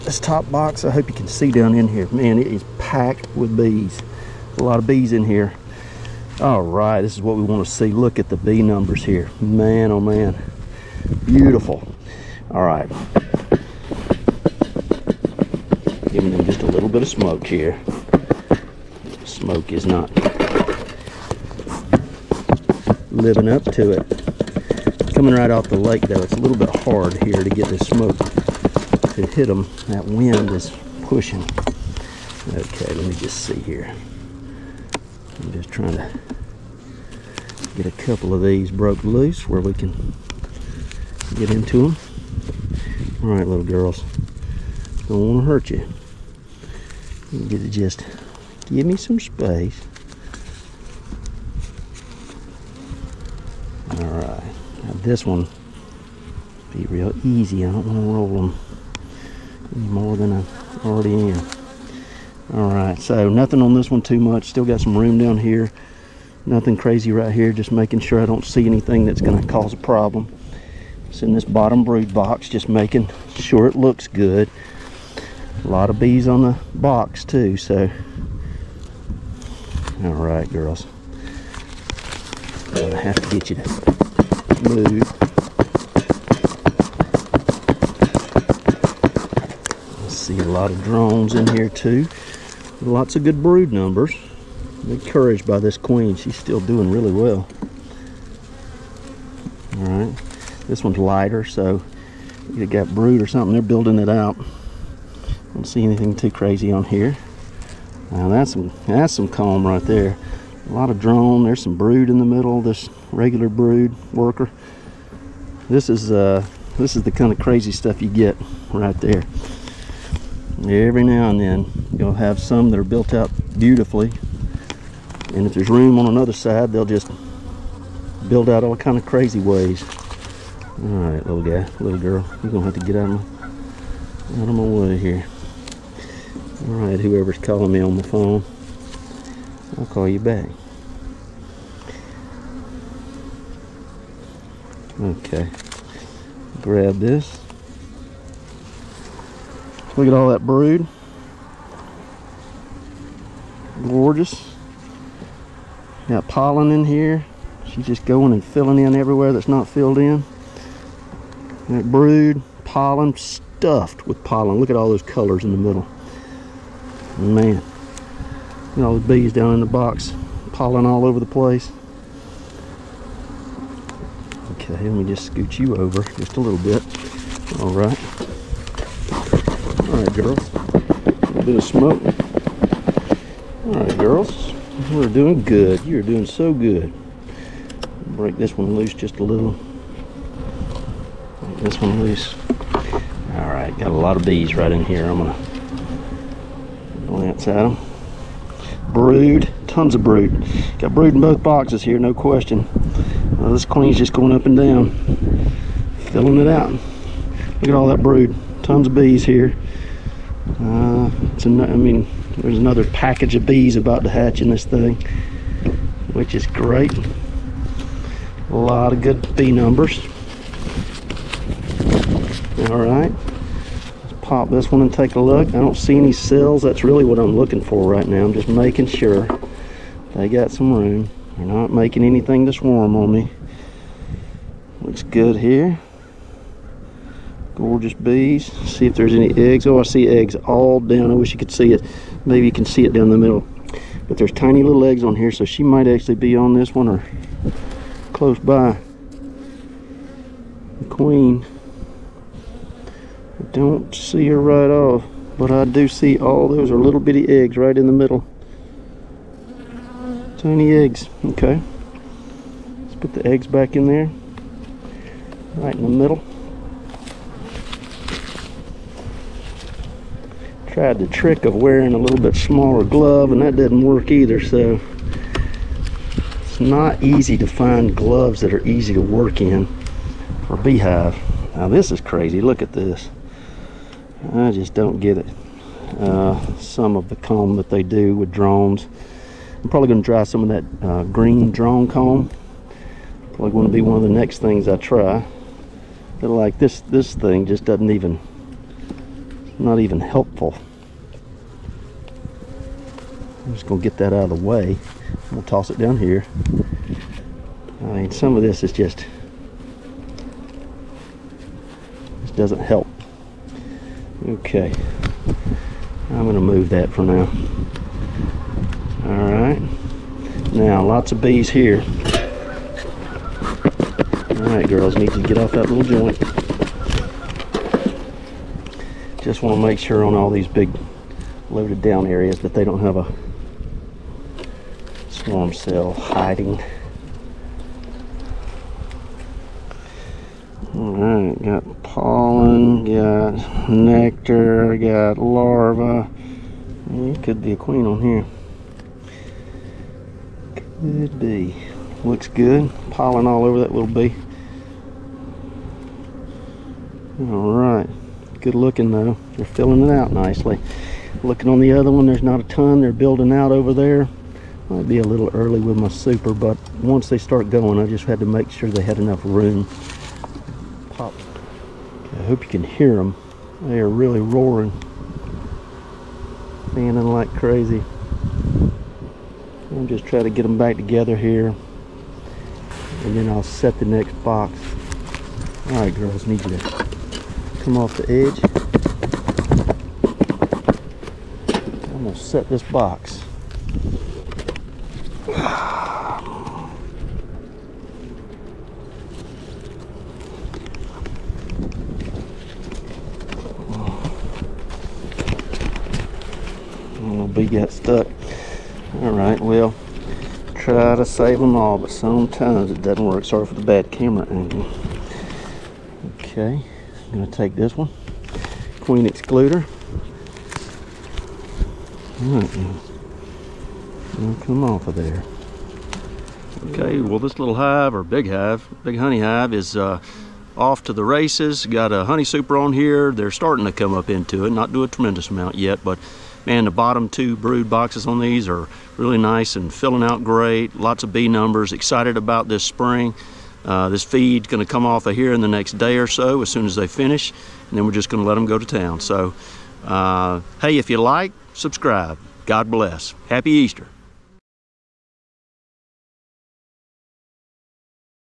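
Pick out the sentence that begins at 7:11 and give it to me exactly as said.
Got a honey super on here.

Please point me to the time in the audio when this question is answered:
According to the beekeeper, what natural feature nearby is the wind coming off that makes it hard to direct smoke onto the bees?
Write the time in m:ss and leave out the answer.
0:25.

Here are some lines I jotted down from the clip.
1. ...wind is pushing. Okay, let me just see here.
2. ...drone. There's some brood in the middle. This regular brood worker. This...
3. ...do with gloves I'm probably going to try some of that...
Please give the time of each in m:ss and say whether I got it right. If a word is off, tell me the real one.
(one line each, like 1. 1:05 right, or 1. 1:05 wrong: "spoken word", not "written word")
1. 0:30 right
2. 1:50 right
3. 4:47 wrong: "drones", not "gloves".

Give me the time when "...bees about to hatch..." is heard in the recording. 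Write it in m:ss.
3:33.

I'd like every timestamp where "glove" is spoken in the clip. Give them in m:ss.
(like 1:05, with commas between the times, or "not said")
4:32, 4:37.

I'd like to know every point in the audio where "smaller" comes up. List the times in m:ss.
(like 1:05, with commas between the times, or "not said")
4:32.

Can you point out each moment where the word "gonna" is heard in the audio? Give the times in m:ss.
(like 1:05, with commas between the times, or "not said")
2:12, 6:32.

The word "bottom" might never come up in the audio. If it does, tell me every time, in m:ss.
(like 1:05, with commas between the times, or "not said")
1:11, 7:16.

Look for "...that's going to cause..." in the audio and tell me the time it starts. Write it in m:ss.
1:09.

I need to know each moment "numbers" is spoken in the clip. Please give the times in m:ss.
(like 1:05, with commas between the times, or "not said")
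0:08, 1:33, 3:39, 7:21.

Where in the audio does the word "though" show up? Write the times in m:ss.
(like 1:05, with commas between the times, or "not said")
0:26, 5:58.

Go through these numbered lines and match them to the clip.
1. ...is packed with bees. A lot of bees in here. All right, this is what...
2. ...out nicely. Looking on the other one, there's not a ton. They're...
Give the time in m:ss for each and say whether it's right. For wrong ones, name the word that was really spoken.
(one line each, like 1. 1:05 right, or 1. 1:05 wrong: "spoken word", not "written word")
1. 0:02 right
2. 5:59 right.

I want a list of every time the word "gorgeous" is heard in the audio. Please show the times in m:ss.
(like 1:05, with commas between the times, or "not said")
2:33, 3:57.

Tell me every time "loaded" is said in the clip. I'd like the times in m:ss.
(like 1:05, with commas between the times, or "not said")
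5:31.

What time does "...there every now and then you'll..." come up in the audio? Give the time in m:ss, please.
1:58.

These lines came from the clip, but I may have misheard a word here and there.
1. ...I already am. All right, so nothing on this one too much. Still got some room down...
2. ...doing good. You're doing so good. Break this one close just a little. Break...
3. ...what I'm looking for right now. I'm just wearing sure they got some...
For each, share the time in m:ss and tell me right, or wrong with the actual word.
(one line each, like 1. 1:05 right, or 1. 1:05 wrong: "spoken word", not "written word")
1. 1:00 right
2. 3:05 wrong: "loose", not "close"
3. 3:47 wrong: "making", not "wearing".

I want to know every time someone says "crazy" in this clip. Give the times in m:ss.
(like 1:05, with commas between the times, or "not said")
1:06, 1:46, 1:57, 2:09, 4:41, 6:17.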